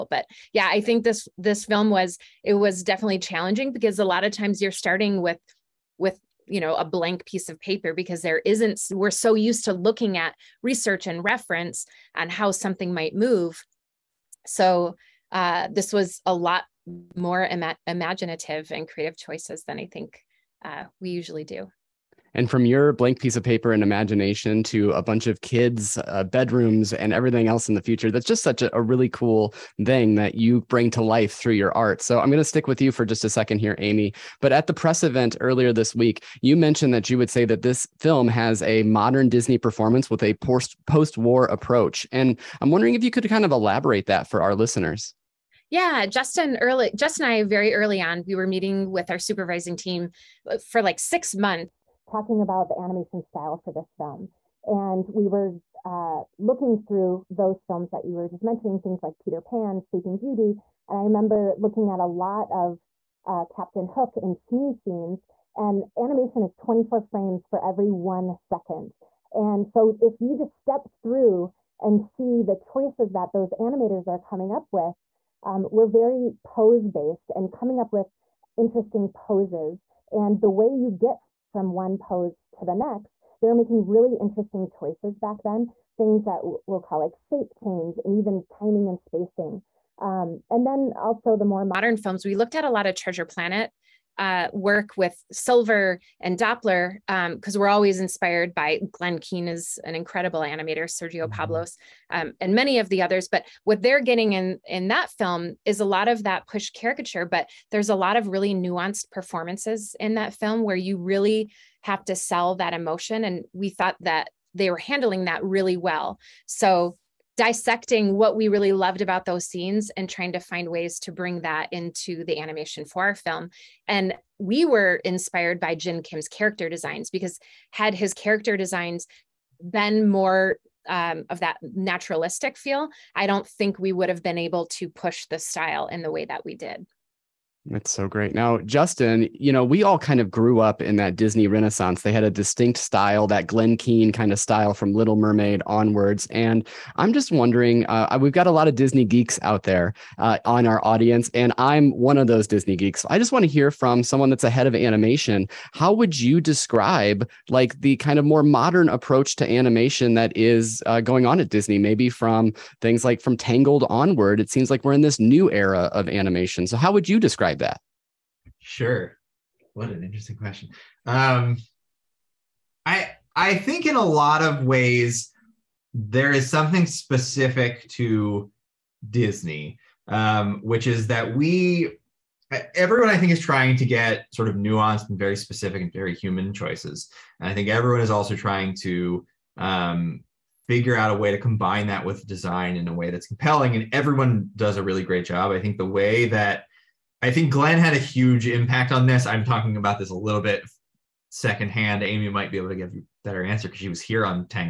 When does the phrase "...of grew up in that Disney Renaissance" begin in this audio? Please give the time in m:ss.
2:20.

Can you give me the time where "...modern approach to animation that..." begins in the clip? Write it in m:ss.
2:38.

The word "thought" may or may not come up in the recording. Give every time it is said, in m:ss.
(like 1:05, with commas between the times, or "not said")
1:53.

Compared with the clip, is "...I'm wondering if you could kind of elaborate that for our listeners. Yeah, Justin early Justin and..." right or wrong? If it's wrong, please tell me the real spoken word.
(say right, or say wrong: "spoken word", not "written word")
right.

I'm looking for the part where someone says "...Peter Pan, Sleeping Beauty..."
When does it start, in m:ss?
0:59.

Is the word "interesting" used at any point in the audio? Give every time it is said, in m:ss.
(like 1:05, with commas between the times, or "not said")
1:18, 1:24, 2:50.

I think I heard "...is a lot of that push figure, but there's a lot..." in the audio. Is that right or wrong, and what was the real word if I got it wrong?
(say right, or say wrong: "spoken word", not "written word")
wrong: "caricature", not "figure".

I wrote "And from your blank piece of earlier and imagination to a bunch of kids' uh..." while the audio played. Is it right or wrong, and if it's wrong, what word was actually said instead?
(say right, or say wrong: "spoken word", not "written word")
wrong: "paper", not "earlier".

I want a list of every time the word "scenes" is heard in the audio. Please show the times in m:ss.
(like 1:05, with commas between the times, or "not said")
1:04, 1:59.